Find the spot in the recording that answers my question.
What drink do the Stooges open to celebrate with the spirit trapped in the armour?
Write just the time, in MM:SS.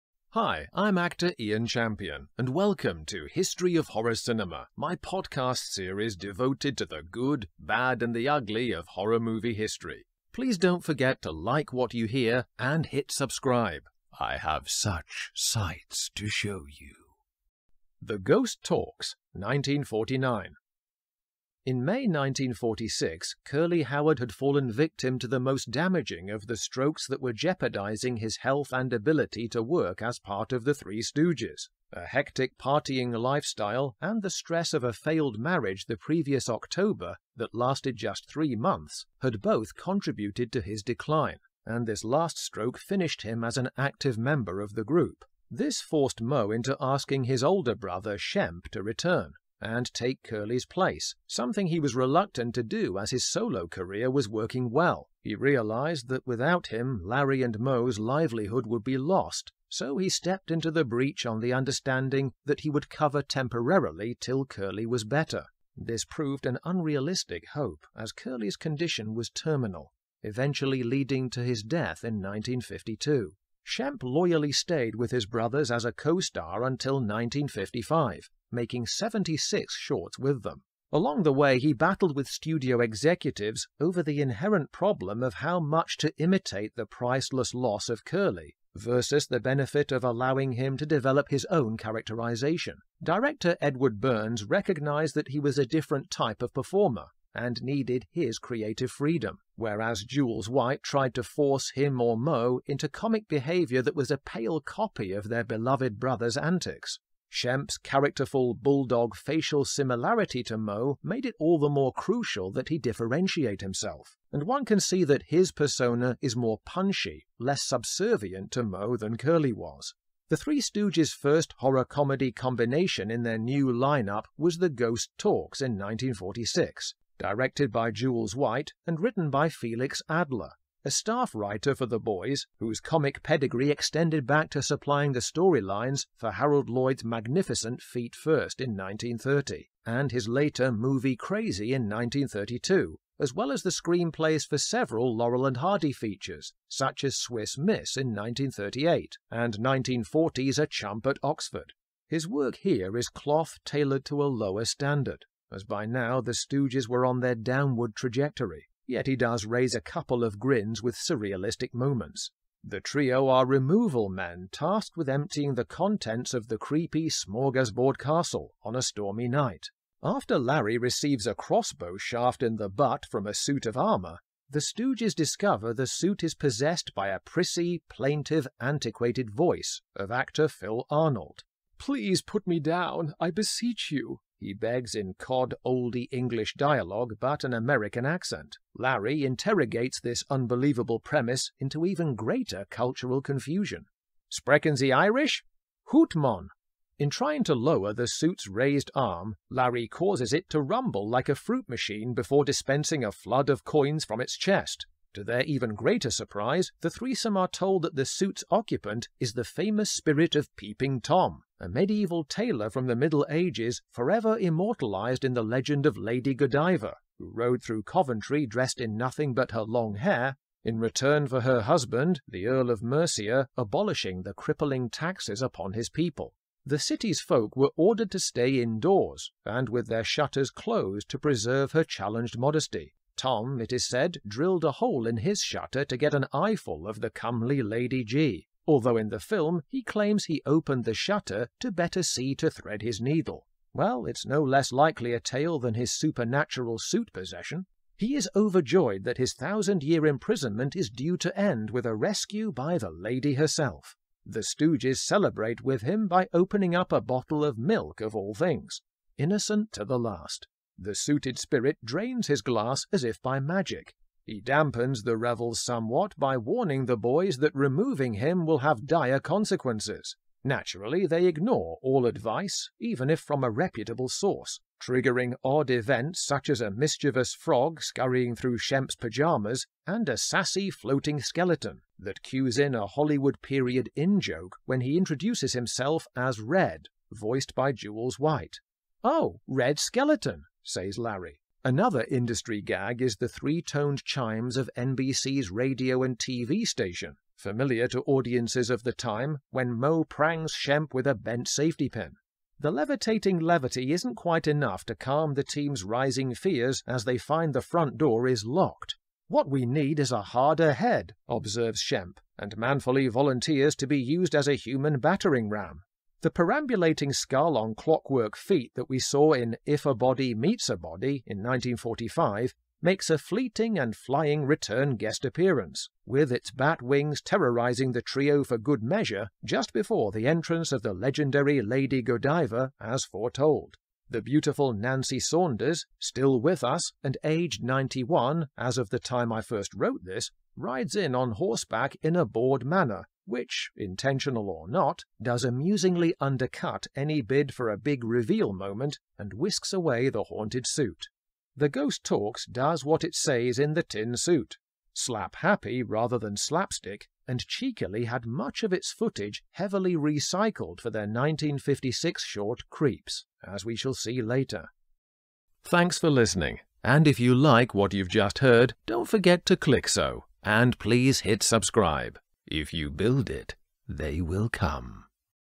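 04:17.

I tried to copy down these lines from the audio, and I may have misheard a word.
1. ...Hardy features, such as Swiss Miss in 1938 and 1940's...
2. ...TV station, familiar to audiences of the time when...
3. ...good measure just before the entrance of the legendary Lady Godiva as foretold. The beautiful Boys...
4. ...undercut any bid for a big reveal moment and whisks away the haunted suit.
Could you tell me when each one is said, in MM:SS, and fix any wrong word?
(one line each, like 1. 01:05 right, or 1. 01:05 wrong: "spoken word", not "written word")
1. 02:25 right
2. 04:56 right
3. 05:28 wrong: "Nancy", not "Boys"
4. 05:46 right.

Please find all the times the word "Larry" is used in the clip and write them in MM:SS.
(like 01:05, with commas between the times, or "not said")
00:57, 02:50, 03:08, 03:19, 04:50.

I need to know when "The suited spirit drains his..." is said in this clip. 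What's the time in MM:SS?
04:20.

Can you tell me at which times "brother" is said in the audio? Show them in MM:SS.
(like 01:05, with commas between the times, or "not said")
00:47, 01:15, 01:45.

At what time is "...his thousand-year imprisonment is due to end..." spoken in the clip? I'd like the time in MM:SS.
04:09.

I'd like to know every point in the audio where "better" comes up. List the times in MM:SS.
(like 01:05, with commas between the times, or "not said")
01:05, 04:01.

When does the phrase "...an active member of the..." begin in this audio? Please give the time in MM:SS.
00:43.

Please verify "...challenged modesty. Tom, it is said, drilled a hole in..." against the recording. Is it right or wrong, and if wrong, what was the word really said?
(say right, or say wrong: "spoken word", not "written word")
right.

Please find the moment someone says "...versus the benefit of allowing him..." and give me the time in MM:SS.
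01:28.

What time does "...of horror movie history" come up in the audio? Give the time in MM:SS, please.
00:08.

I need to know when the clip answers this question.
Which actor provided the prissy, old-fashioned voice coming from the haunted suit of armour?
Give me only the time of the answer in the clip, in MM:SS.
03:00.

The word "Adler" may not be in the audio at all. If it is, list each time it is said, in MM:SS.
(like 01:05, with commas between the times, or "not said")
02:10.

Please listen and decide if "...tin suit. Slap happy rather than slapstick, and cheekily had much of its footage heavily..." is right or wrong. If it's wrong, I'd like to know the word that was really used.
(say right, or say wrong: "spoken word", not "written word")
right.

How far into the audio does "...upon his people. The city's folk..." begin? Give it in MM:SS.
03:45.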